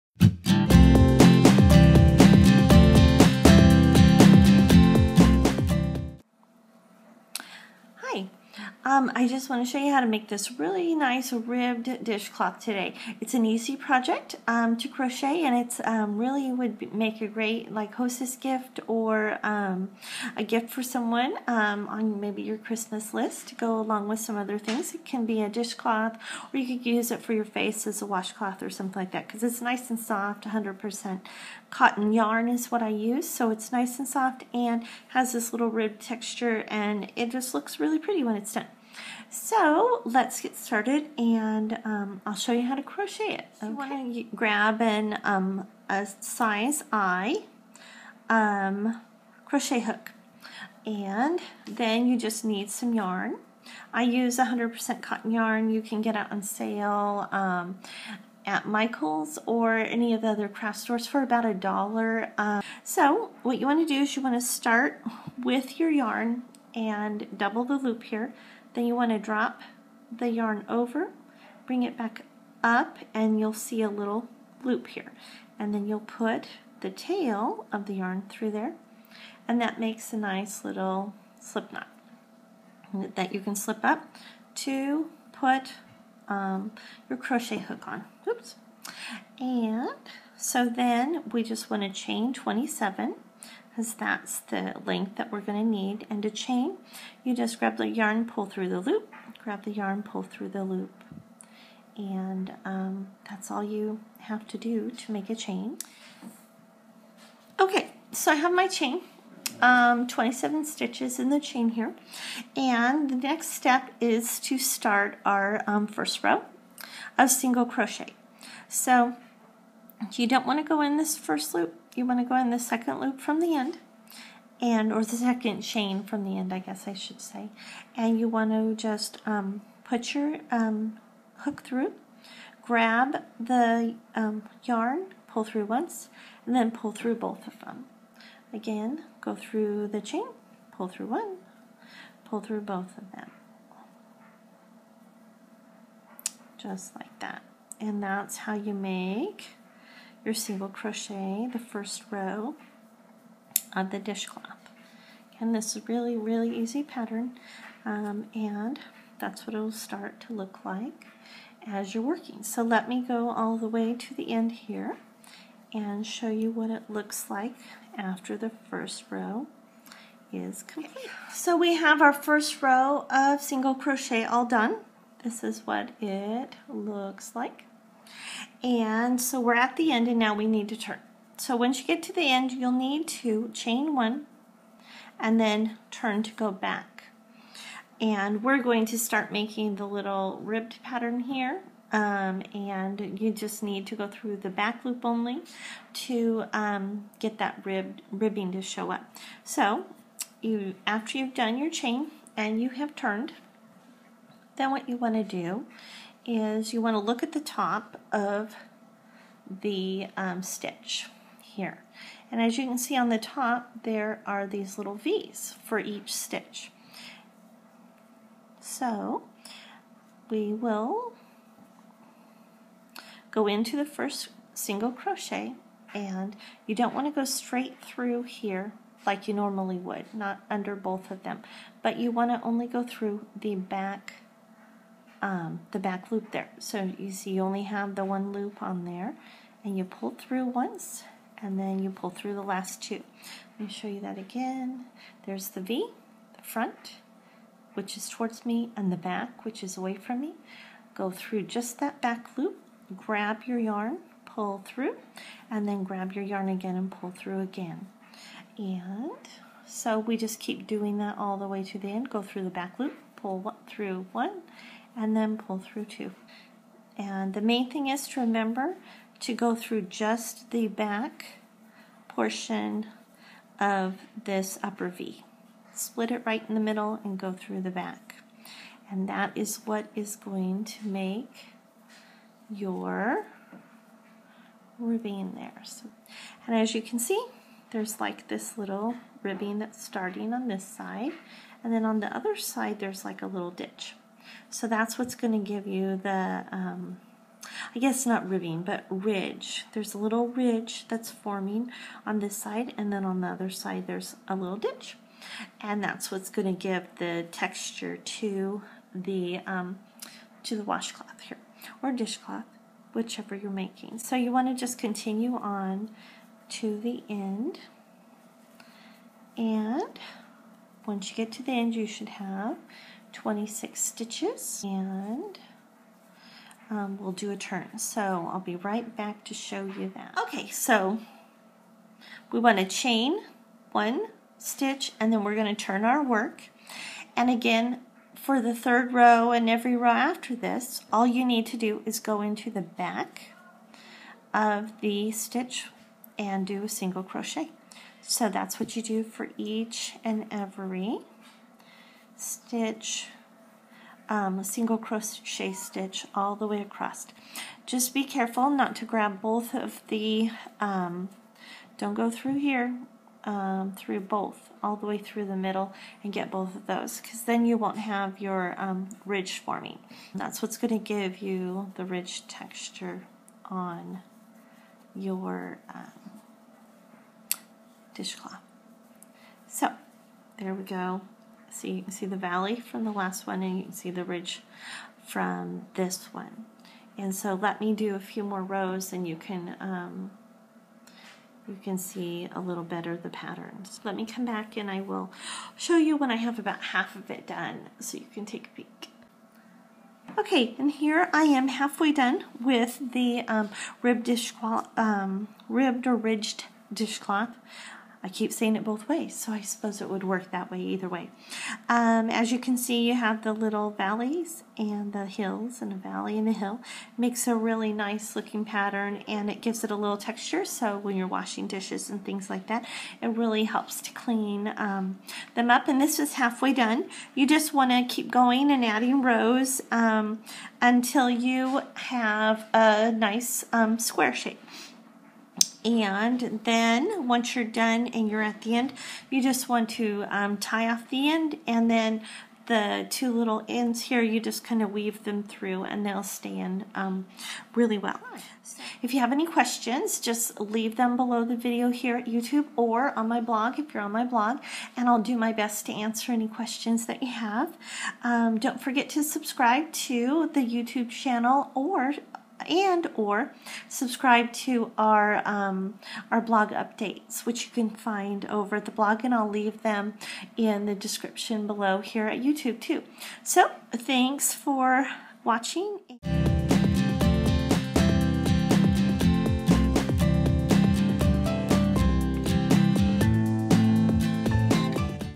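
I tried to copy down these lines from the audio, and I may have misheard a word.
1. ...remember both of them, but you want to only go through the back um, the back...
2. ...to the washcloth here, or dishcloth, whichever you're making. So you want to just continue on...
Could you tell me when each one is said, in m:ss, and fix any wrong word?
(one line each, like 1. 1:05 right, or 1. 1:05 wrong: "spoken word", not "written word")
1. 3:50 wrong: "under", not "remember"
2. 5:10 right.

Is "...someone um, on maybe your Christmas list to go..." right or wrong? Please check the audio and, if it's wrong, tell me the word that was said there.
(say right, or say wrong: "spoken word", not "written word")
right.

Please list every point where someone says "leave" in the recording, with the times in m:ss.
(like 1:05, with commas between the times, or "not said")
7:30, 7:49.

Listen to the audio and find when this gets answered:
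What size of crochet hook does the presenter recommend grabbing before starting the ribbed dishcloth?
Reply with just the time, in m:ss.
0:46.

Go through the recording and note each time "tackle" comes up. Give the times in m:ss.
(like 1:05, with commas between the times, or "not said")
not said.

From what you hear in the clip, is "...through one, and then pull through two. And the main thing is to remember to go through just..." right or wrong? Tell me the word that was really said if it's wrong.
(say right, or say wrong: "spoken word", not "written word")
right.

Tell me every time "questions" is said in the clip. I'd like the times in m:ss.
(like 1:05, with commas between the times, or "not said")
7:29, 7:36.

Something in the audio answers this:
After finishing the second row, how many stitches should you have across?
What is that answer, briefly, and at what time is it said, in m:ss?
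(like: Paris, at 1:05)
26, at 5:23.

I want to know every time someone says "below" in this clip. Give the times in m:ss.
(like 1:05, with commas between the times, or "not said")
7:30, 7:51.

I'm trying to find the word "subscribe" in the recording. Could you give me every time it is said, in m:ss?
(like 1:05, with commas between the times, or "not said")
7:39, 7:43.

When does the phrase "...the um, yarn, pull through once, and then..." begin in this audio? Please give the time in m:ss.
2:13.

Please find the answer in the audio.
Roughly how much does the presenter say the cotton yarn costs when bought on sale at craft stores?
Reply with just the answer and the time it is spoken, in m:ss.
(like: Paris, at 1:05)
about a dollar, at 1:01.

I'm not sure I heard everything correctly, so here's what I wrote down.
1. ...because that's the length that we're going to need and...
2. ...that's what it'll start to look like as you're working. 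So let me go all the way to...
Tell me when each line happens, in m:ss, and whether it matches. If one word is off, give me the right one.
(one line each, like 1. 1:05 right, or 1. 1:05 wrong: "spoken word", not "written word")
1. 1:33 right
2. 2:39 right.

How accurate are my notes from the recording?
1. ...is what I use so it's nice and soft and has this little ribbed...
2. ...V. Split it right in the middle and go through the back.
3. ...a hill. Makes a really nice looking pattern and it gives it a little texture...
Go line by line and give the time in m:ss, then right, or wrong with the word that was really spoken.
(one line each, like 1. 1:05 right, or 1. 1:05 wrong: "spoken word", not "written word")
1. 0:32 right
2. 4:34 right
3. 6:56 right.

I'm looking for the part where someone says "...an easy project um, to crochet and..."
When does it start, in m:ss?
0:13.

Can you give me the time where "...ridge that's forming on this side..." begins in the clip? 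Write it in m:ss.
5:00.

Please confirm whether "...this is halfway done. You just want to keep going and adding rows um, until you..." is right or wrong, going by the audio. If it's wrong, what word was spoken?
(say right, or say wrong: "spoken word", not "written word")
right.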